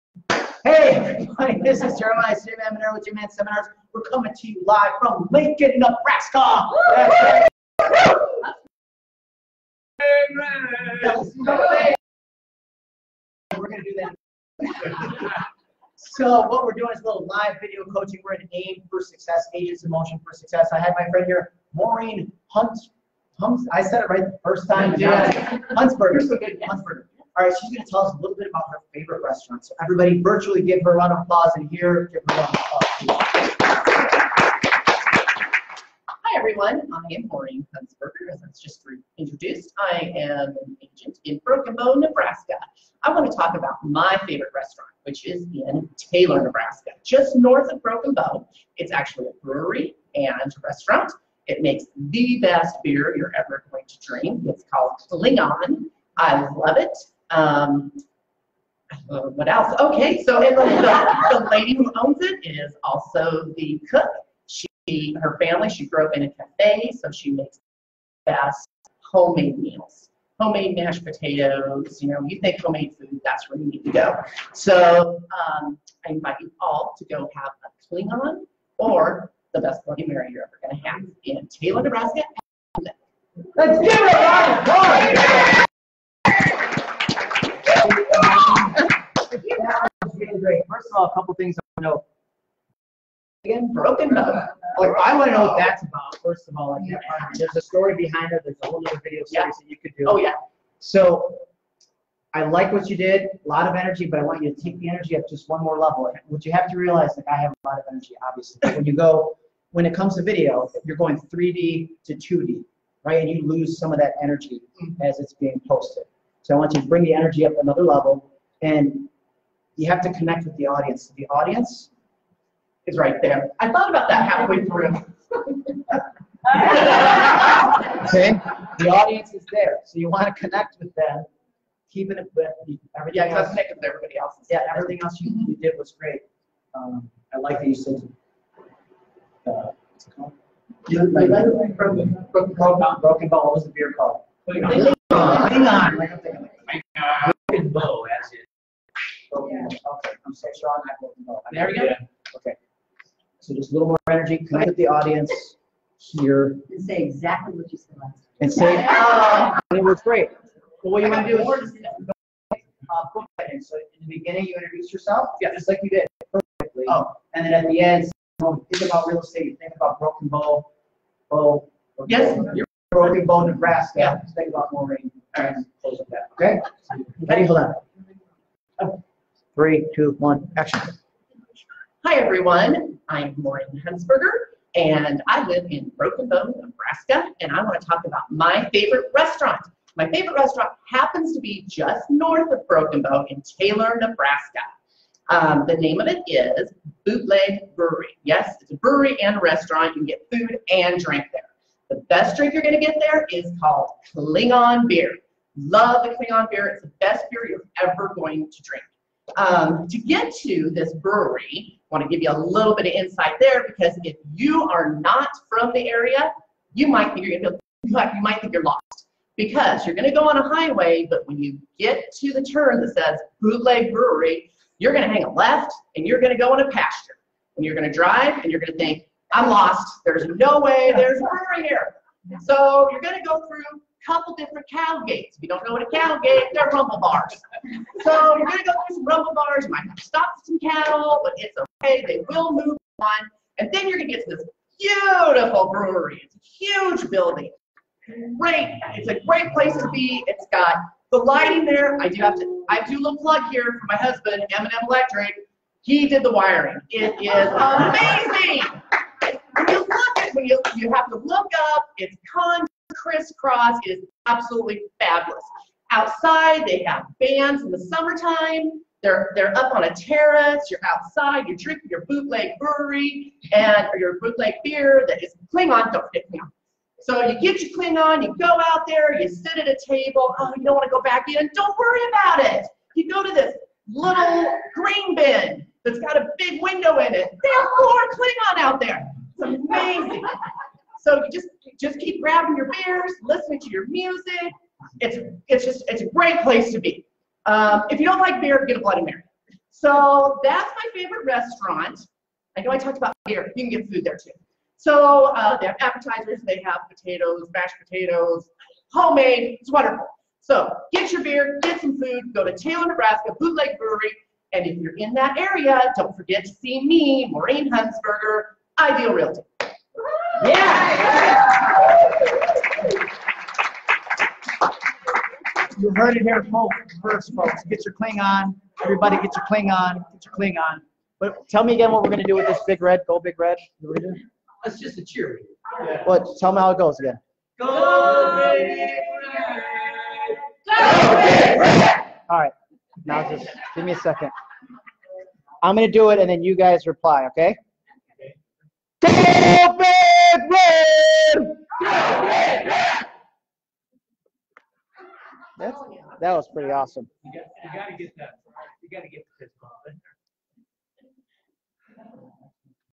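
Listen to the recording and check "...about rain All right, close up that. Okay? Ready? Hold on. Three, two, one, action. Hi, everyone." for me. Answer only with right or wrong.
right.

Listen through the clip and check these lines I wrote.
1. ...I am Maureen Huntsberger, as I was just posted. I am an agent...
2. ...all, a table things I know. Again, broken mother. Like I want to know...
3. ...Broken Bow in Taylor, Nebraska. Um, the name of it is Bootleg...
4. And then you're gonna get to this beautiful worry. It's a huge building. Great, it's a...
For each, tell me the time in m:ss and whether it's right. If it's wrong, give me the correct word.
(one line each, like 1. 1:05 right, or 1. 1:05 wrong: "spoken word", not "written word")
1. 0:36 wrong: "introduced", not "posted"
2. 1:30 wrong: "couple", not "table"
3. 3:12 right
4. 4:03 wrong: "brewery", not "worry".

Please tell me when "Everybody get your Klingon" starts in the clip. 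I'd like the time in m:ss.
5:28.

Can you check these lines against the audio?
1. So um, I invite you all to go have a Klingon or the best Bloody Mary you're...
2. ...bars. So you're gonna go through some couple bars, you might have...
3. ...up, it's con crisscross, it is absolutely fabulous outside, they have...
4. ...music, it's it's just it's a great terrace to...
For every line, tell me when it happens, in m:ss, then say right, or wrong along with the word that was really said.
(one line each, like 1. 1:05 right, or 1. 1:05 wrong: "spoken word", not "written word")
1. 1:14 right
2. 3:56 wrong: "rumble", not "couple"
3. 4:21 right
4. 4:53 wrong: "place", not "terrace".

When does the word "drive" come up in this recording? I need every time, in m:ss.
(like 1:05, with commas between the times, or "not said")
3:47.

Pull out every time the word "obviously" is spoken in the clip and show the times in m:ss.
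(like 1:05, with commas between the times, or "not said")
1:48.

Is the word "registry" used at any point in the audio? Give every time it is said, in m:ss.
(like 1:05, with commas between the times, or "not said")
not said.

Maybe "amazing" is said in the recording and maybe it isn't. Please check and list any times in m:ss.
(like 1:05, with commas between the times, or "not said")
4:17, 4:49.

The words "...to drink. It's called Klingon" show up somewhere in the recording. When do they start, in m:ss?
0:53.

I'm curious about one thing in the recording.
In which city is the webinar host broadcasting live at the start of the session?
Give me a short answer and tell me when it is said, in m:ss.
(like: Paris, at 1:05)
Lincoln, Nebraska, at 0:05.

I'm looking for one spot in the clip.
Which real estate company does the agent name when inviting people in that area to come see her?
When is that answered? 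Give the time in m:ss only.
5:18.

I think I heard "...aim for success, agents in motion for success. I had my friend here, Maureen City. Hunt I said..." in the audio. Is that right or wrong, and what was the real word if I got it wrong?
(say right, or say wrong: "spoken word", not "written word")
wrong: "Hunt", not "City".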